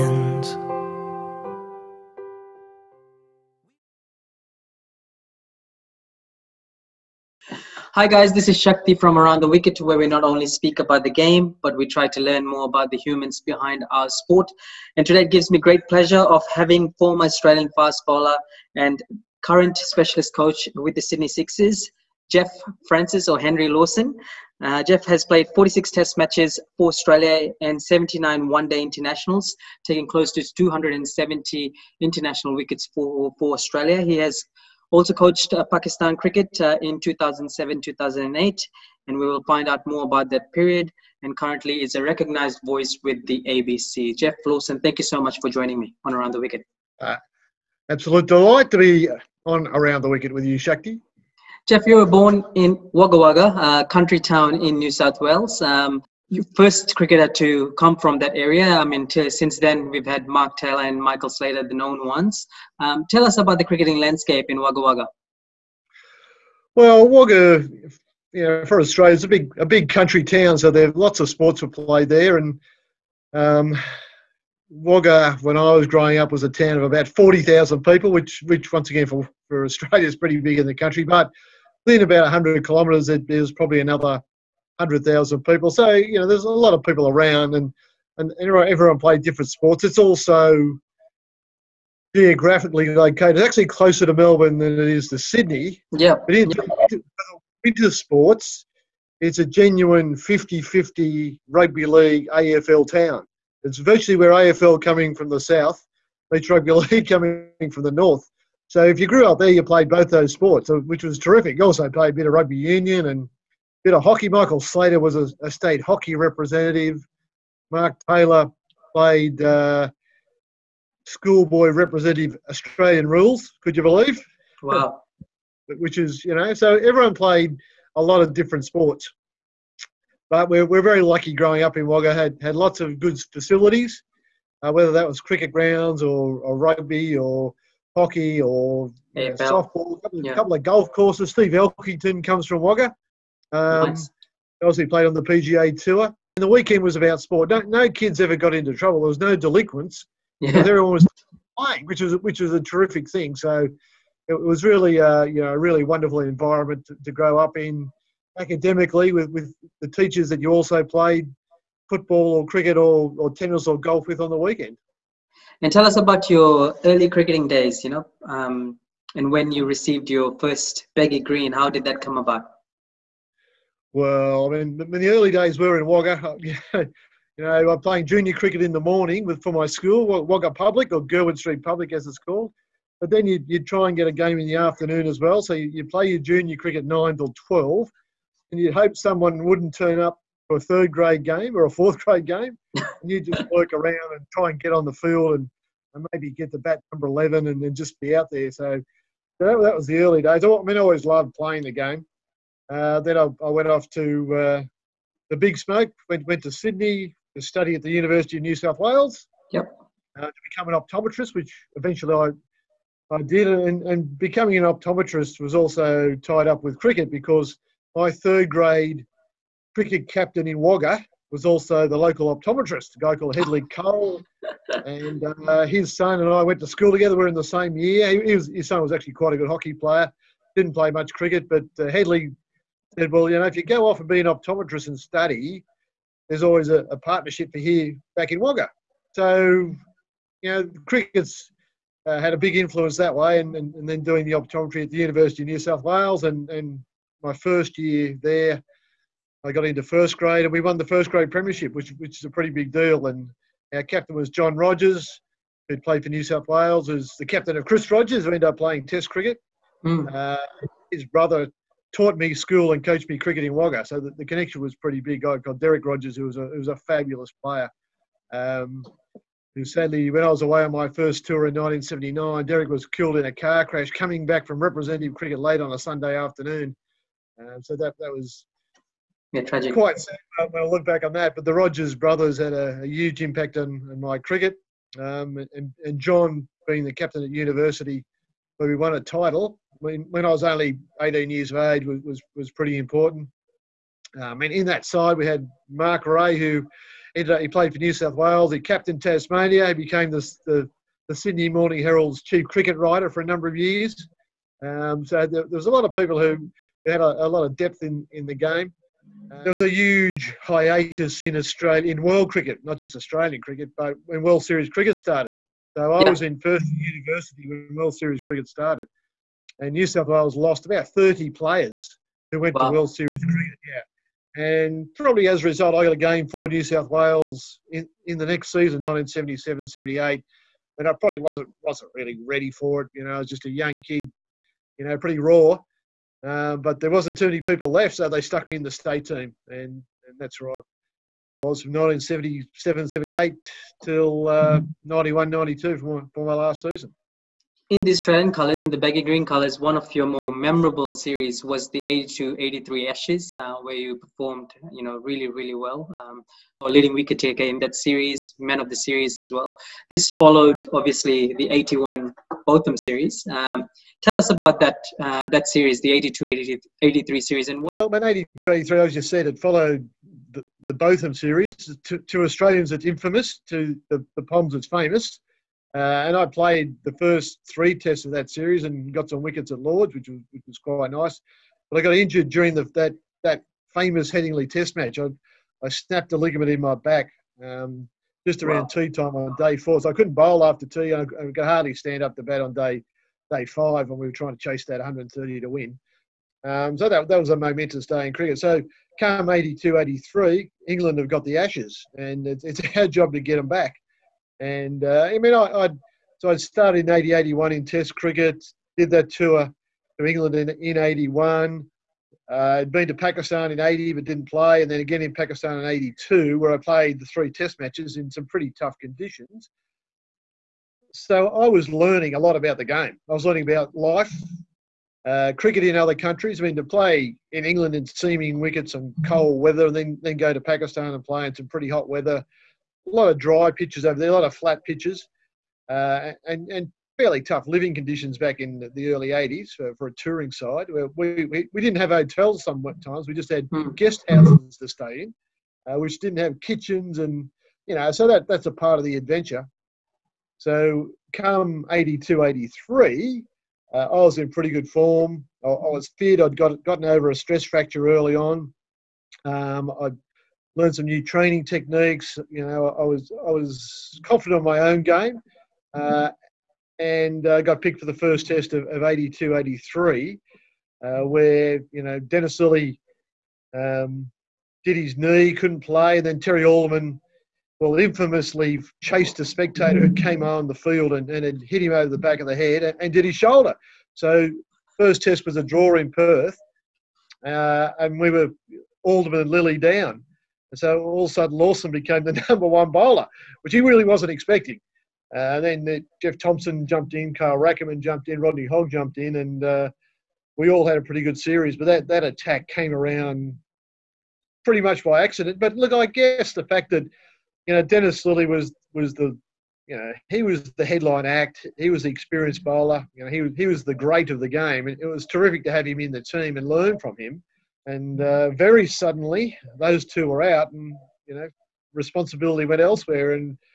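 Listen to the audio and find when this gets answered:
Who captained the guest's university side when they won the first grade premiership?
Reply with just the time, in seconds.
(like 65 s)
254 s.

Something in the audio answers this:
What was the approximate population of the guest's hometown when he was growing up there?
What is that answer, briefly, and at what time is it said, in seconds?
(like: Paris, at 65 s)
40,000, at 77 s.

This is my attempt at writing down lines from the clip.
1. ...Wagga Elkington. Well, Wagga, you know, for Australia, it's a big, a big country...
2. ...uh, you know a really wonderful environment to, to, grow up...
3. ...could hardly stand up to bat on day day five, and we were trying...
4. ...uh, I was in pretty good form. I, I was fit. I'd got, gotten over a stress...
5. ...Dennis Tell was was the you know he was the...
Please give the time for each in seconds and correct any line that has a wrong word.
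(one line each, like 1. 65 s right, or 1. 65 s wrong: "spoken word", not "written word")
1. 64 s wrong: "Wagga", not "Elkington"
2. 154 s right
3. 391 s right
4. 453 s right
5. 507 s wrong: "Lillee", not "Tell".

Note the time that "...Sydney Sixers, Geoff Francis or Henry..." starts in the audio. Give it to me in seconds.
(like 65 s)
21 s.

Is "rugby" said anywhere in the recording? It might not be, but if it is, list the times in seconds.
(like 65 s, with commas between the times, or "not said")
101 s, 106 s, 112 s, 136 s.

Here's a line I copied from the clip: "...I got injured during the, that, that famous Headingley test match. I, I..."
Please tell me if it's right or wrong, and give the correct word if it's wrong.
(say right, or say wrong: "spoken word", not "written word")
right.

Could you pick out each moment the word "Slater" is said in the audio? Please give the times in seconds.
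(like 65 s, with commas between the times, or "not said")
61 s, 114 s.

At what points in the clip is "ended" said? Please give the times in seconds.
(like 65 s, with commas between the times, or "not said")
258 s, 297 s.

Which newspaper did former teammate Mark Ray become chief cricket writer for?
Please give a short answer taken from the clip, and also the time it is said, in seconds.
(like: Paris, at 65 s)
Sydney Morning Herald, at 301 s.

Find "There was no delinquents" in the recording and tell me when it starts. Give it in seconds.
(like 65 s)
148 s.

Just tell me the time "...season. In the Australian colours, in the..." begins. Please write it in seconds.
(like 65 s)
346 s.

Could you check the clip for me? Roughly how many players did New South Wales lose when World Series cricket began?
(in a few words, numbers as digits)
30.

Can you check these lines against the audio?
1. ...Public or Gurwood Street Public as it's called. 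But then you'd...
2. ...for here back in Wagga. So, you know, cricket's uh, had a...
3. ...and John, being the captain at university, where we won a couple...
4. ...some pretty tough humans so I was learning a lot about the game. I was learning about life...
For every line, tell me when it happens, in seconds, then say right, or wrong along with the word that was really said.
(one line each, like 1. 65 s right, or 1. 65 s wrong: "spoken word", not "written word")
1. 180 s right
2. 237 s right
3. 285 s wrong: "title", not "couple"
4. 418 s wrong: "conditions", not "humans".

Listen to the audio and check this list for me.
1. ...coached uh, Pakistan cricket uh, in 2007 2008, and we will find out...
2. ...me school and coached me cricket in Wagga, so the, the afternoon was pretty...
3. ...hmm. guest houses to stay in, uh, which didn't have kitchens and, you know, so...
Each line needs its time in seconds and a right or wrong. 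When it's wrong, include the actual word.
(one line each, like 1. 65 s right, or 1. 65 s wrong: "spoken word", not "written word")
1. 35 s right
2. 262 s wrong: "connection", not "afternoon"
3. 443 s right.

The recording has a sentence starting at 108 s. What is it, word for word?
So if you grew up there, you played both those sports, which was terrific.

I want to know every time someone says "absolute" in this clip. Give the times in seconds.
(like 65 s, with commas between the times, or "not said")
47 s.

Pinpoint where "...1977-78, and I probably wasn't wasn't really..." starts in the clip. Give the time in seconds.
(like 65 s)
328 s.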